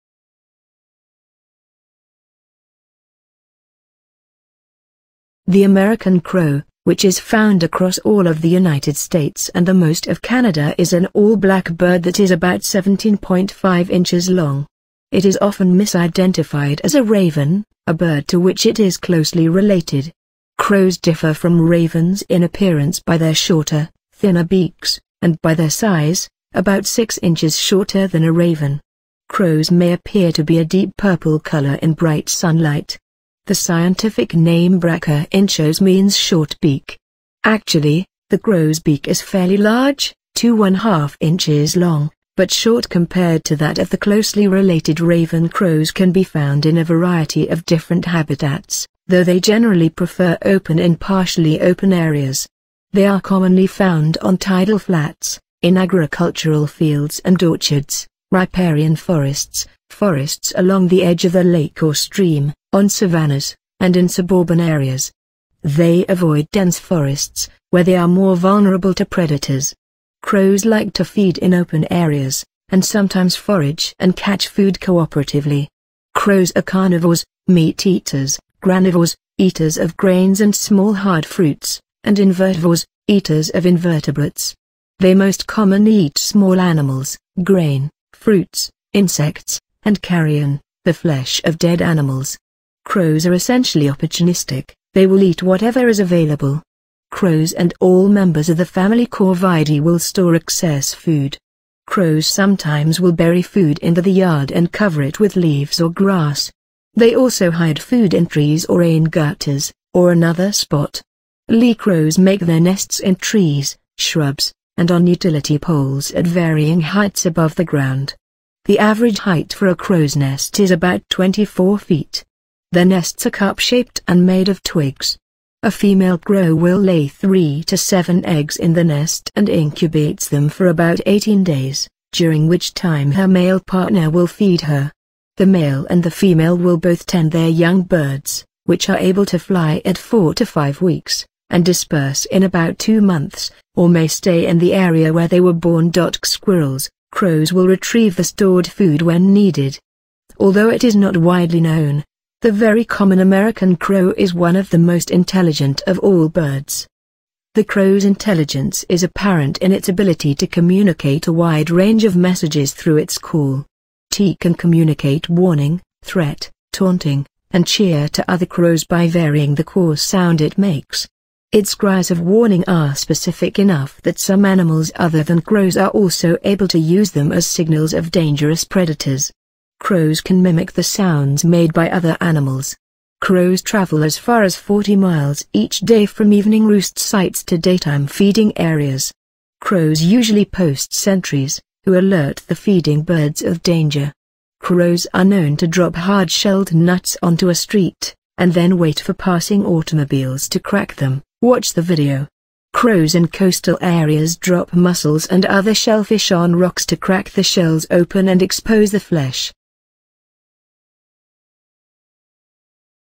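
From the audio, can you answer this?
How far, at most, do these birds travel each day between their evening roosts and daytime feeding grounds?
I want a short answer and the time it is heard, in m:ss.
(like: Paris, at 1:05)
40 miles, at 3:04.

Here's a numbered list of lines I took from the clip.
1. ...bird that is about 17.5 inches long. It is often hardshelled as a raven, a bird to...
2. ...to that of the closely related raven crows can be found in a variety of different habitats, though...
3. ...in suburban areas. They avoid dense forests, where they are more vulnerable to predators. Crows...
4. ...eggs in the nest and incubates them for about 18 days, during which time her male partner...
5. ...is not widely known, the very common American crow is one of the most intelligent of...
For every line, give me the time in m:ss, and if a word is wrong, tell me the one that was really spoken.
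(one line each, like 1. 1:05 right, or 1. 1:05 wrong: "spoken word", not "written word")
1. 0:11 wrong: "misidentified", not "hardshelled"
2. 0:43 right
3. 1:03 right
4. 2:08 right
5. 2:30 right.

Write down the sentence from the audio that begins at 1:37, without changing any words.
Crows and all members of the family Corvidae will store excess food.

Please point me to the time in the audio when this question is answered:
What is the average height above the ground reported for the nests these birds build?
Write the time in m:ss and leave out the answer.
2:01.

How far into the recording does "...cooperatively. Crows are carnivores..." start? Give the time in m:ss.
1:14.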